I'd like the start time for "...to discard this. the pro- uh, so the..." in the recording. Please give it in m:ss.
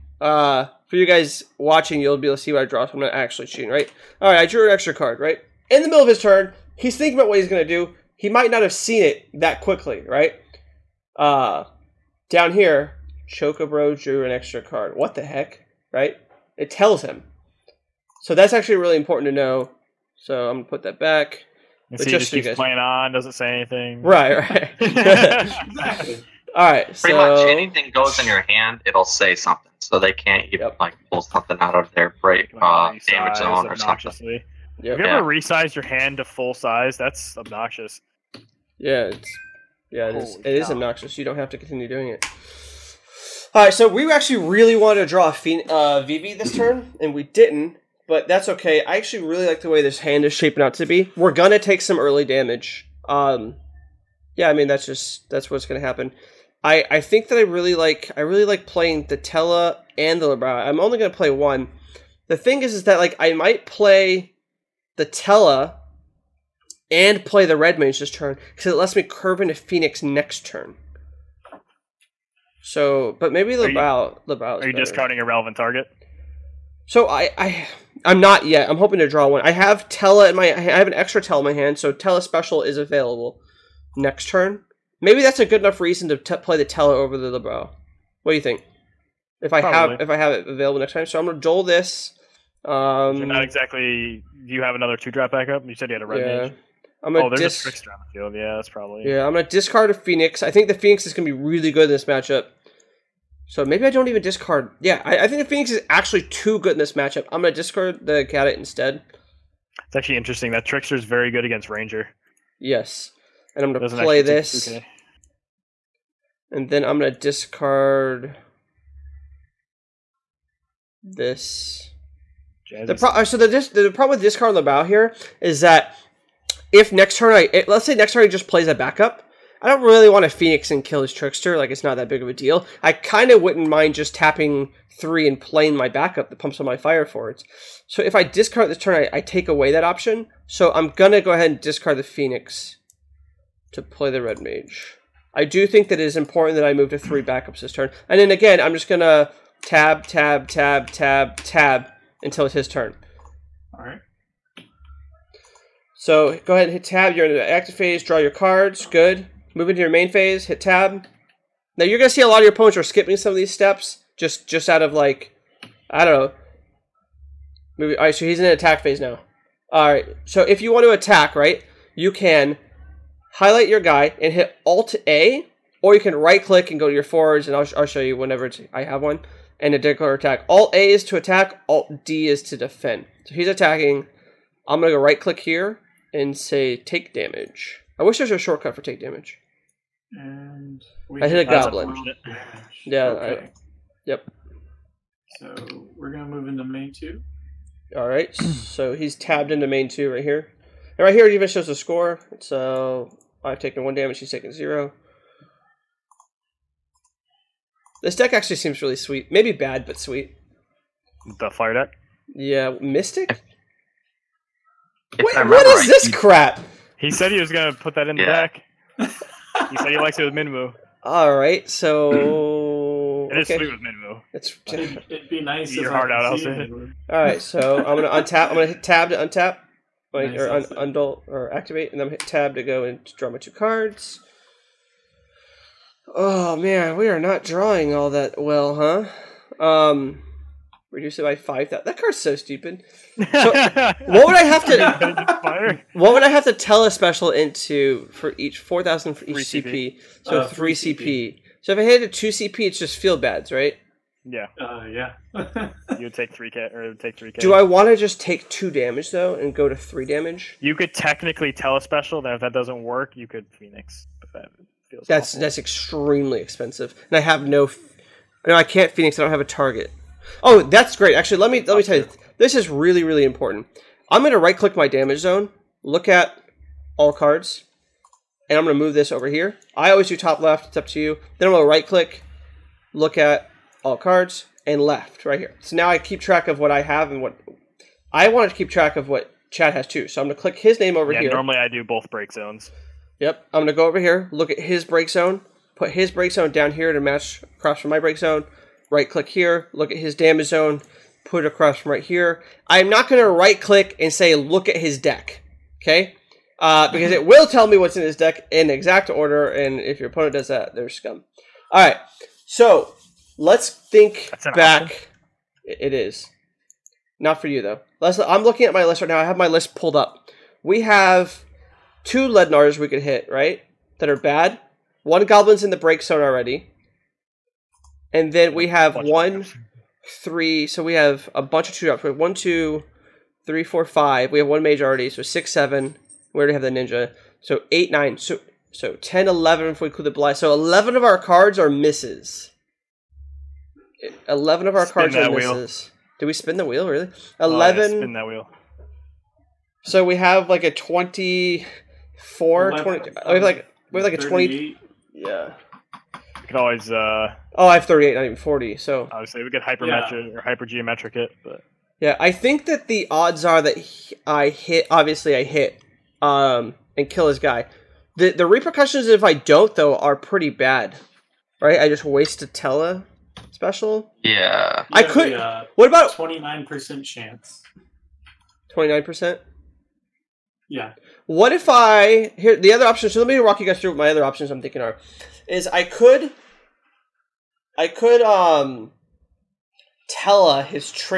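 1:57.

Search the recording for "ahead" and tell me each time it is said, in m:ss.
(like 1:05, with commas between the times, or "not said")
2:21, 2:36.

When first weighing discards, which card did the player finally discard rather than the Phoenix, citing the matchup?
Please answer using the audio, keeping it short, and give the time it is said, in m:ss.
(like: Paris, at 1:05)
cadet, at 1:47.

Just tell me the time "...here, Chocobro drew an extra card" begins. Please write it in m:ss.
0:12.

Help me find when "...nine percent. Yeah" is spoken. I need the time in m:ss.
6:18.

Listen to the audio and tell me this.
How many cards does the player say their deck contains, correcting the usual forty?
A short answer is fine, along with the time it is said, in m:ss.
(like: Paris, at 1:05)
38, at 5:57.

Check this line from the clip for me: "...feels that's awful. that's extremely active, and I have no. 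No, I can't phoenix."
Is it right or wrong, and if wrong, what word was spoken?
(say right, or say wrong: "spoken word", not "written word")
wrong: "expensive", not "active".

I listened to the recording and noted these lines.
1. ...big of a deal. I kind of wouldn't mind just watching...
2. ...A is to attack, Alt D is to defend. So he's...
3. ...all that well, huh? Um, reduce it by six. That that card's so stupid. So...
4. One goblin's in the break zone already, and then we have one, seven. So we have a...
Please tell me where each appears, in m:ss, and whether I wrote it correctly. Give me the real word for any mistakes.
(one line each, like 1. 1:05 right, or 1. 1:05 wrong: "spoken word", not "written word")
1. 2:12 wrong: "tapping", not "watching"
2. 3:00 right
3. 3:57 wrong: "five", not "six"
4. 5:25 wrong: "three", not "seven".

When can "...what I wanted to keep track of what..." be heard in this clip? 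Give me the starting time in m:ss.
4:47.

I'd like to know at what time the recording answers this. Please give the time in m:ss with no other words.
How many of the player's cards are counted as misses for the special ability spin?
5:40.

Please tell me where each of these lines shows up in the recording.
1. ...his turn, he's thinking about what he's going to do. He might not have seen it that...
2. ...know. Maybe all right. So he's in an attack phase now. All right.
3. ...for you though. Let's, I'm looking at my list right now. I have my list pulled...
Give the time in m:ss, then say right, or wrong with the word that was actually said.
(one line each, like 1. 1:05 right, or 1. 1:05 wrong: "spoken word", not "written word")
1. 0:06 right
2. 2:46 right
3. 5:17 right.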